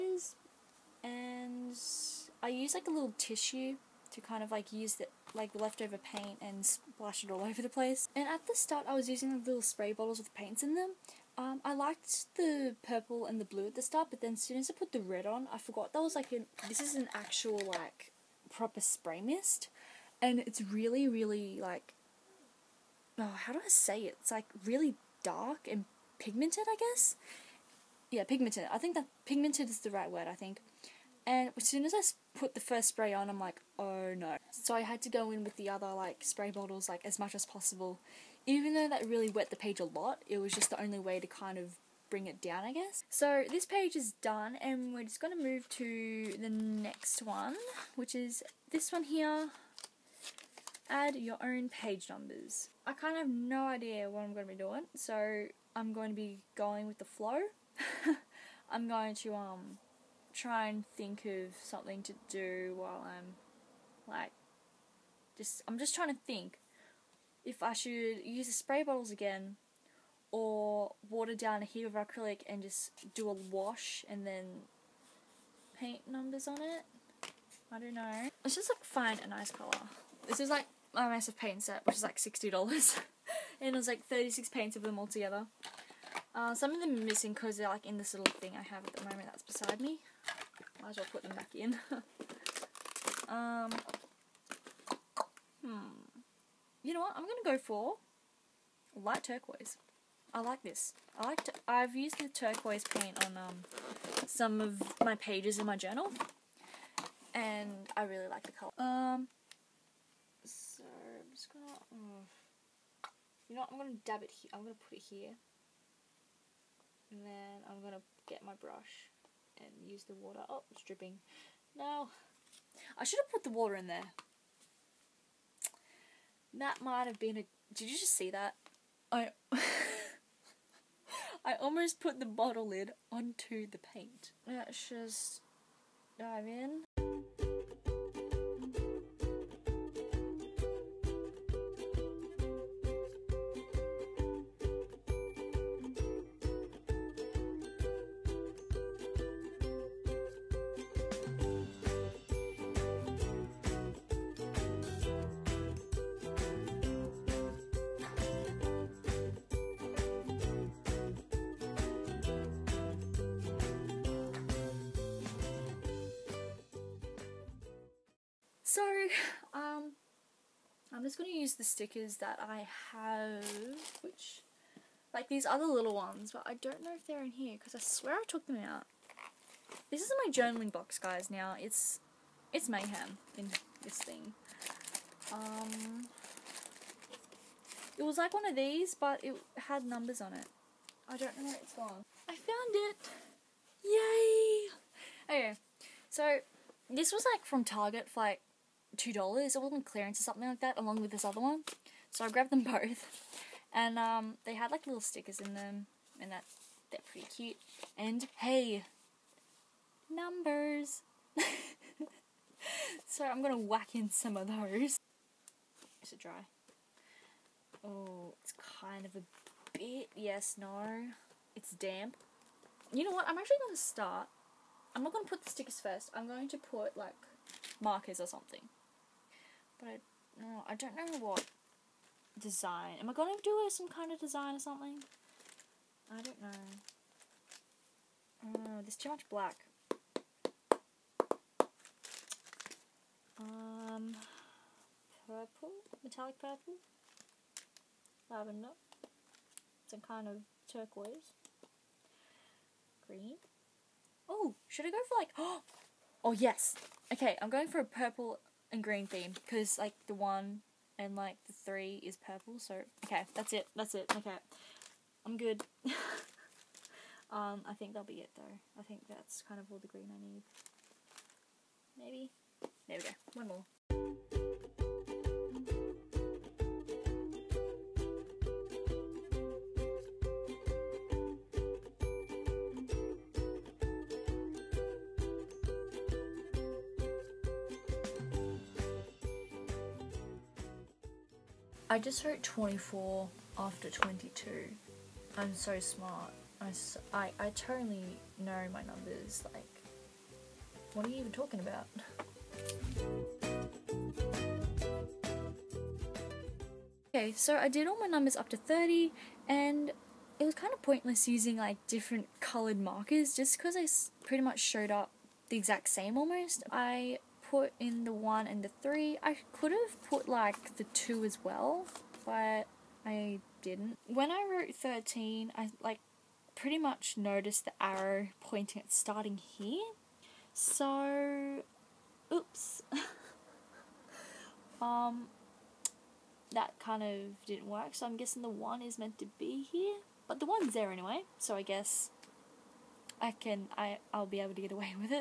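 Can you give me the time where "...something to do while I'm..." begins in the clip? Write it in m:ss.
1:01.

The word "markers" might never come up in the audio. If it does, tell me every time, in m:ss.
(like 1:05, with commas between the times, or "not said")
3:47, 5:12.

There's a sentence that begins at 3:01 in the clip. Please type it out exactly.
It's, it's mayhem in this thing.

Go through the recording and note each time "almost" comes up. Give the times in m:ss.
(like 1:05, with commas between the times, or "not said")
2:11, 5:16.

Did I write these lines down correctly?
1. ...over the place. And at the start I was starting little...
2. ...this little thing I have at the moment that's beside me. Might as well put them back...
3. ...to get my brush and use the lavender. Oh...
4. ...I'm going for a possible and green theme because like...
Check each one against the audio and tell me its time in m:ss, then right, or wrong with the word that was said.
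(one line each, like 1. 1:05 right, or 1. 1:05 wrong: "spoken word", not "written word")
1. 0:07 wrong: "using", not "starting"
2. 1:27 right
3. 1:57 wrong: "water", not "lavender"
4. 4:17 wrong: "purple", not "possible".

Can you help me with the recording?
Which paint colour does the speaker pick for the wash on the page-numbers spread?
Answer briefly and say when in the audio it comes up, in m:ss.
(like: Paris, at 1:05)
light turquoise, at 1:38.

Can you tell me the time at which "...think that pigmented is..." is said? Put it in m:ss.
0:28.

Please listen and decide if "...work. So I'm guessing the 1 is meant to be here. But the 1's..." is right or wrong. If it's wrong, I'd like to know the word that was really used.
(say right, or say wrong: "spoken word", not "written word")
right.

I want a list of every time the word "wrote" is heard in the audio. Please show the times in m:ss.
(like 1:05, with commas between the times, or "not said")
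4:52, 5:24.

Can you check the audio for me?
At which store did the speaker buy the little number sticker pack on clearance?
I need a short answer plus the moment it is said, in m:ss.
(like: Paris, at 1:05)
Target, at 3:17.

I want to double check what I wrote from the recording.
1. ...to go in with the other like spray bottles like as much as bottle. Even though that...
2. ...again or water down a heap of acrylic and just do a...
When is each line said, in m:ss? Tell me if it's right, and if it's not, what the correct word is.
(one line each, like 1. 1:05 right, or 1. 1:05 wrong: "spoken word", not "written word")
1. 0:35 wrong: "possible", not "bottle"
2. 1:09 right.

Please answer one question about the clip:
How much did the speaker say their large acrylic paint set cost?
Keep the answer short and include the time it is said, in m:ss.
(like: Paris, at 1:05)
$60, at 1:22.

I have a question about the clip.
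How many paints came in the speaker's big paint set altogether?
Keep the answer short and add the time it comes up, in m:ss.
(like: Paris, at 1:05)
36, at 1:24.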